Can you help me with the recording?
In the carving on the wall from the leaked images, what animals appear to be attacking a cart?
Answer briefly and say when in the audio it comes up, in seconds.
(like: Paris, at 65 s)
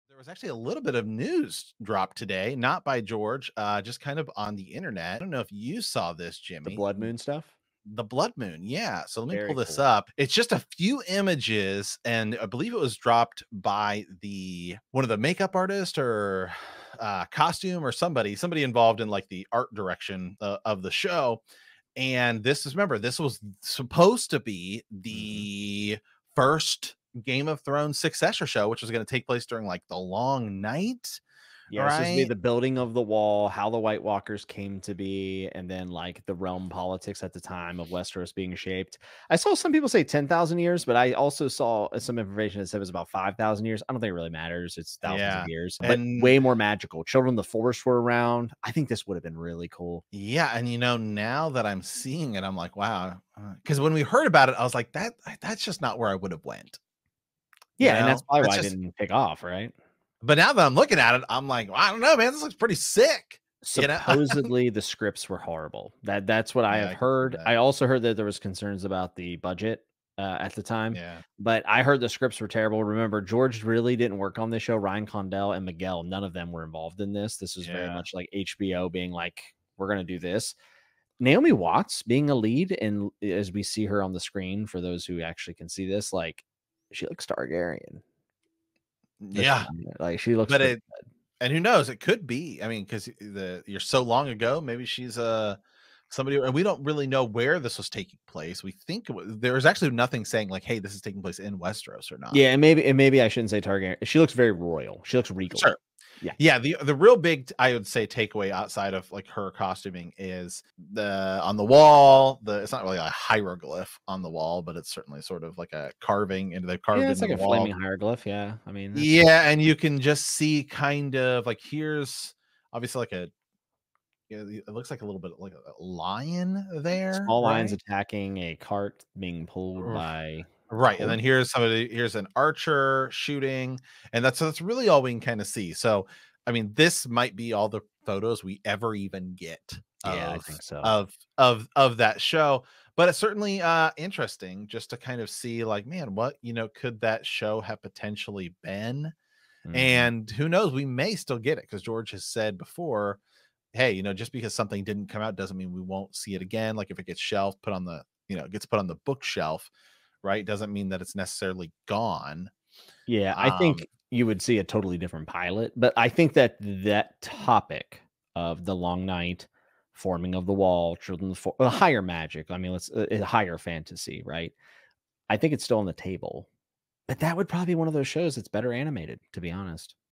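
lions, at 127 s.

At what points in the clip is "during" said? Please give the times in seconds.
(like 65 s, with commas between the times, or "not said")
29 s.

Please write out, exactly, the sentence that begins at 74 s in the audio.
Ryan Condal and Miguel, none of them were involved in this.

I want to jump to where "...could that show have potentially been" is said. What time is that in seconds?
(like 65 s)
146 s.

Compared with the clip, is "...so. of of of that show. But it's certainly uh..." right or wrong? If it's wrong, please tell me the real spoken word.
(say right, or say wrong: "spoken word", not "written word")
right.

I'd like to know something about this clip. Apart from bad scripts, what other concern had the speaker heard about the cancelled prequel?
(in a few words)
the budget.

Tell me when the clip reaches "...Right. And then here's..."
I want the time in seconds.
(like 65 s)
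130 s.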